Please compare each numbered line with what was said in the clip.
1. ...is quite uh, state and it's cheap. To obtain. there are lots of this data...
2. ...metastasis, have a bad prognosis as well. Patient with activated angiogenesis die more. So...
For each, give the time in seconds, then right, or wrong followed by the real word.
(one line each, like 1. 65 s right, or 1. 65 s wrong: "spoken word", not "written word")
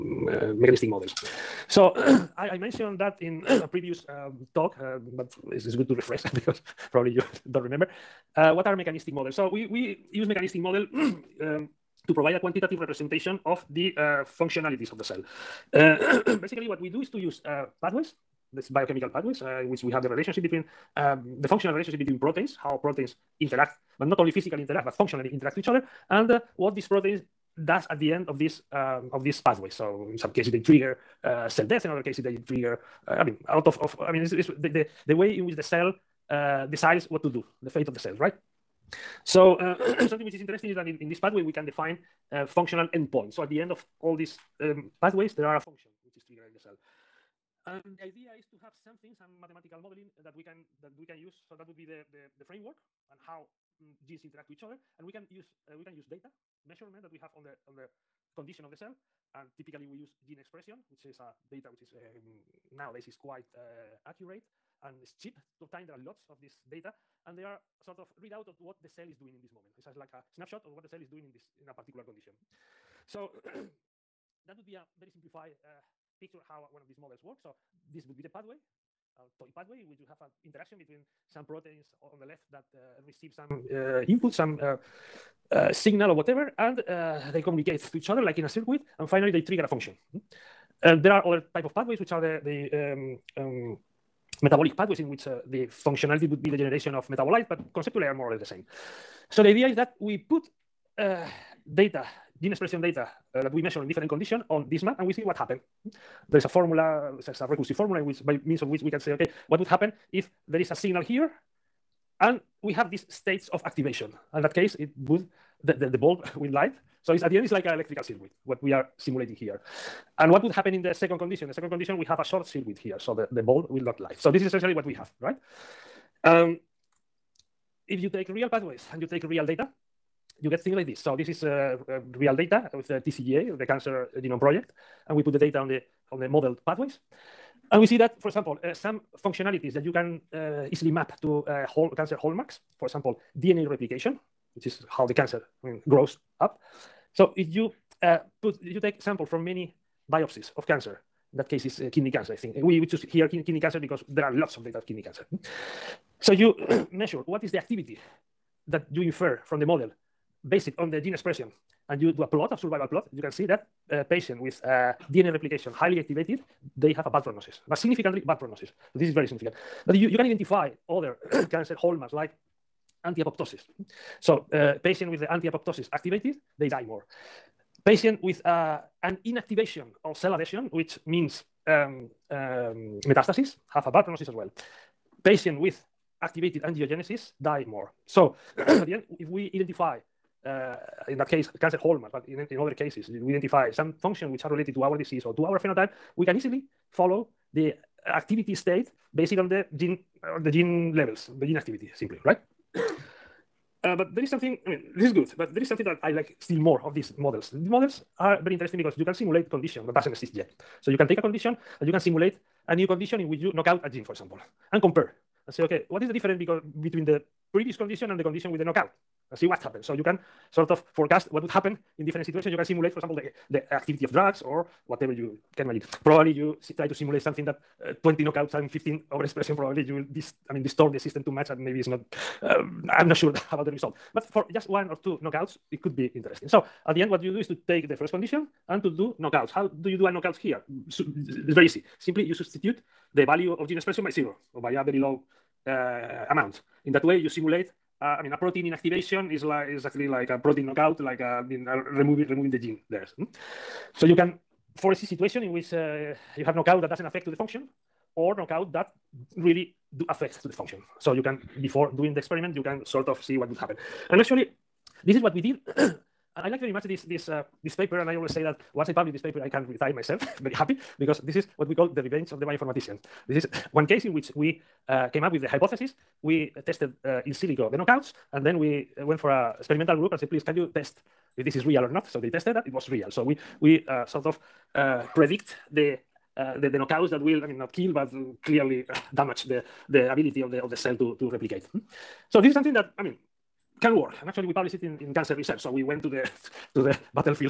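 1. 63 s wrong: "accurate", not "state"
2. 183 s right.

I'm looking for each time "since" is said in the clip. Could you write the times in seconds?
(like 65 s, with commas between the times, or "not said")
not said.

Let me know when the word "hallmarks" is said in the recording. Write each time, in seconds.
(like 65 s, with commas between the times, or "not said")
142 s, 171 s, 191 s.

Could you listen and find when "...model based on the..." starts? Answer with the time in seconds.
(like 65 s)
159 s.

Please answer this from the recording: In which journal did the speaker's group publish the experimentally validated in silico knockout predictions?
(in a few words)
Cancer Research.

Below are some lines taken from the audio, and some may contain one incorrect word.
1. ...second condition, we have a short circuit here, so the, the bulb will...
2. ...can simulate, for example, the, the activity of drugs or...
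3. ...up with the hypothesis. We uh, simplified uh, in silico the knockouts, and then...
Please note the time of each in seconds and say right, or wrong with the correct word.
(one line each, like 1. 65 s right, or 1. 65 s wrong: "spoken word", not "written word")
1. 121 s right
2. 222 s right
3. 275 s wrong: "tested", not "simplified".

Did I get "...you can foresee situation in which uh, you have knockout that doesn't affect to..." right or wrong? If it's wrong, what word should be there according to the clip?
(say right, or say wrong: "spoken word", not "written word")
right.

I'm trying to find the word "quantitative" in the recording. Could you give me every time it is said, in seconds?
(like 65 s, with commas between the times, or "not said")
12 s.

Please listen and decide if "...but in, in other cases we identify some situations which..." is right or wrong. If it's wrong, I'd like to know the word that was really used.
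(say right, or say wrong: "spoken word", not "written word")
wrong: "functions", not "situations".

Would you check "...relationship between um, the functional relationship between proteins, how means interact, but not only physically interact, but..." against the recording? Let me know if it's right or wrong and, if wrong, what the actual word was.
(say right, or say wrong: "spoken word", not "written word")
wrong: "proteins", not "means".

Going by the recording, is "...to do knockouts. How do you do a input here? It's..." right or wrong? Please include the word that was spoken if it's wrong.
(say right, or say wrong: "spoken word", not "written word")
wrong: "knockout", not "input".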